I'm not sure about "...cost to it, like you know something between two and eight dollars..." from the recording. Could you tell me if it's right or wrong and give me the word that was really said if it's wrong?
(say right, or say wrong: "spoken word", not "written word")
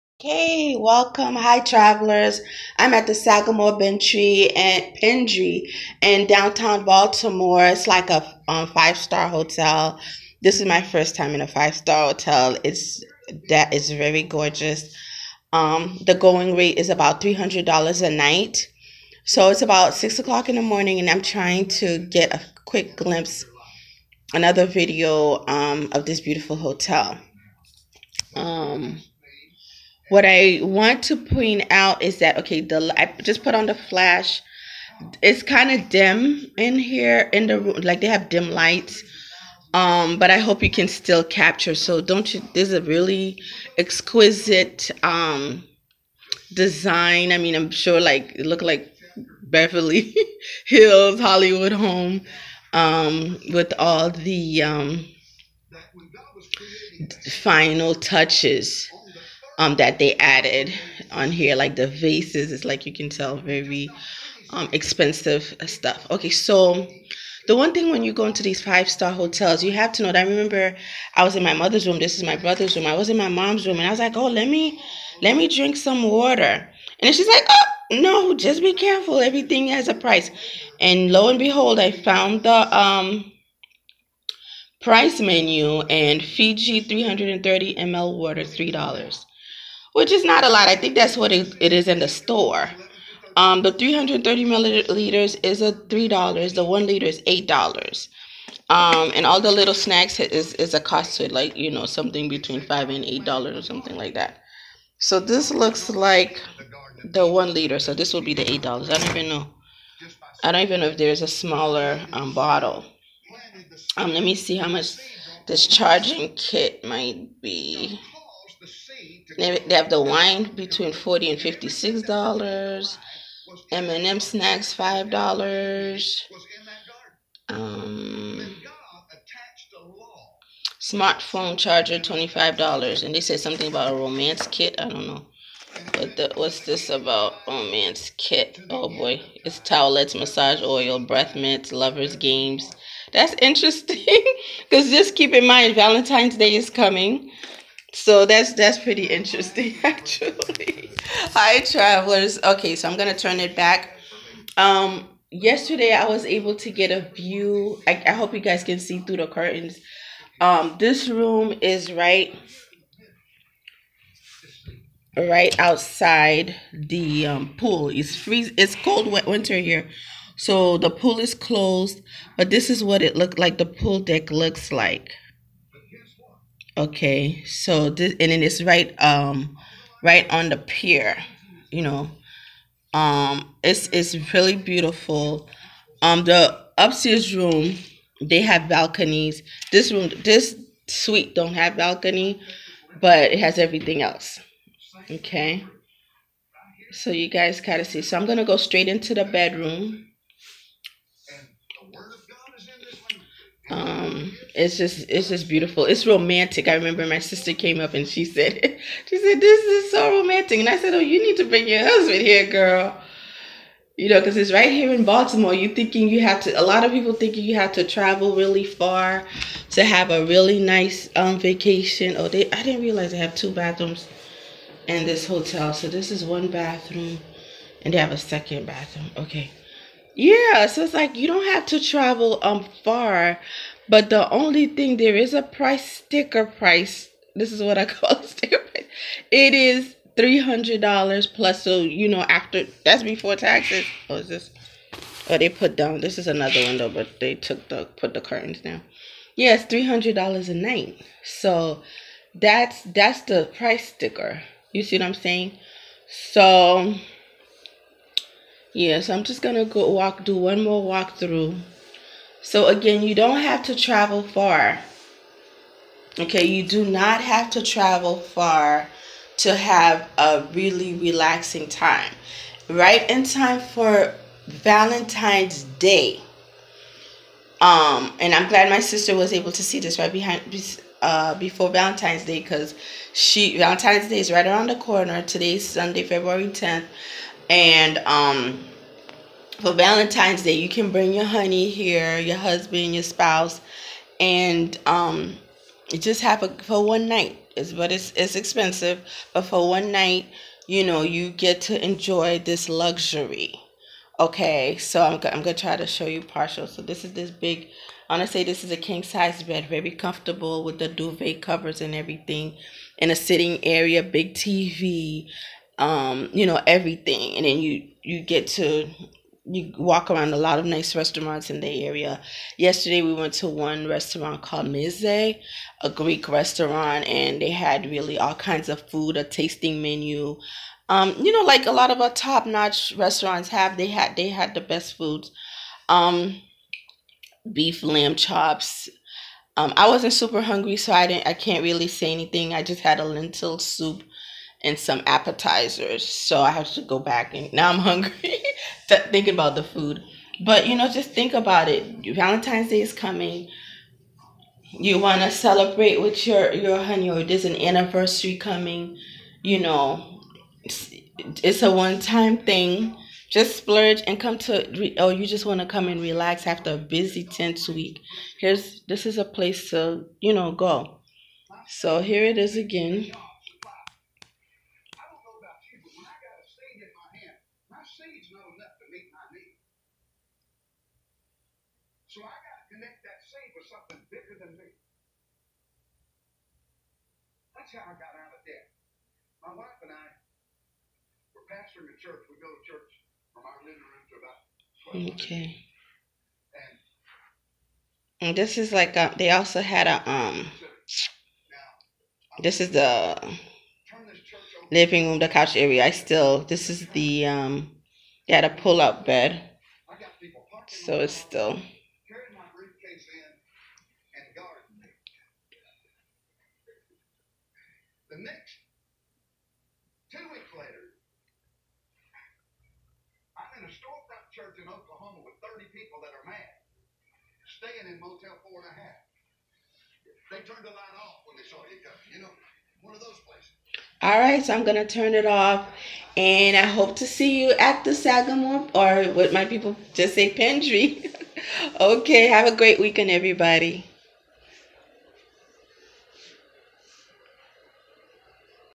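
wrong: "five", not "two".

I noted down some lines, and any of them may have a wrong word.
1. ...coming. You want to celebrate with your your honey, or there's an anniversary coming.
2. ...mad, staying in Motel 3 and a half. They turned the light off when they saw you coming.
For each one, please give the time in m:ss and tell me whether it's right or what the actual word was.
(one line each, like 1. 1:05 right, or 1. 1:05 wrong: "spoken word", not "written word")
1. 5:52 right
2. 7:06 wrong: "4", not "3".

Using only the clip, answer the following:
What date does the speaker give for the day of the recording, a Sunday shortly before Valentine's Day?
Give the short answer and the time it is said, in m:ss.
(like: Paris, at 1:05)
February 10th, at 4:46.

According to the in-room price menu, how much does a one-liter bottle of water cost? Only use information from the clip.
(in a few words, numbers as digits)
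$8.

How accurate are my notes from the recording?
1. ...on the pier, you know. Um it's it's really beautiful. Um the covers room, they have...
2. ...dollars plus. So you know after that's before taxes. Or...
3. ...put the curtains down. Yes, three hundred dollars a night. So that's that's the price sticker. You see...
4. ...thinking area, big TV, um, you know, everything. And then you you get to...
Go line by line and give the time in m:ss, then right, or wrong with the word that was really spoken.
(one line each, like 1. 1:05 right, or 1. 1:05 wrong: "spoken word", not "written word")
1. 3:00 wrong: "upstairs", not "covers"
2. 4:00 right
3. 4:07 right
4. 5:13 wrong: "sitting", not "thinking".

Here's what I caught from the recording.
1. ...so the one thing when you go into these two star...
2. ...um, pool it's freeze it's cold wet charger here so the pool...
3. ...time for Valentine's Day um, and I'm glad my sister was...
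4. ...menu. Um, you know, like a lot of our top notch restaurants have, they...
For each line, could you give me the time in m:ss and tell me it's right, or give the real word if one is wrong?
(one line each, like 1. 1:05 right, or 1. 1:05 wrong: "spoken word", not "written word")
1. 1:06 wrong: "five", not "two"
2. 2:47 wrong: "winter", not "charger"
3. 4:33 right
4. 5:29 right.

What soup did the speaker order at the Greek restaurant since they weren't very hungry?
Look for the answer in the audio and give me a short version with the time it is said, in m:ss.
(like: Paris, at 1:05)
Lentil soup, at 5:43.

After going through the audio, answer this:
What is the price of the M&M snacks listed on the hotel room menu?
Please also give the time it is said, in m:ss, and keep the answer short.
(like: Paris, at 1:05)
$5, at 2:03.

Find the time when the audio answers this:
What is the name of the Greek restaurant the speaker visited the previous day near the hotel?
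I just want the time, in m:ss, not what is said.
5:24.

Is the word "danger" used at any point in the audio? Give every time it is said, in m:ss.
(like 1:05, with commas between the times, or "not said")
not said.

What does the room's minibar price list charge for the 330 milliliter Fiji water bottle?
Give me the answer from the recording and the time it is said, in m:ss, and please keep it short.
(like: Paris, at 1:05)
$3, at 1:28.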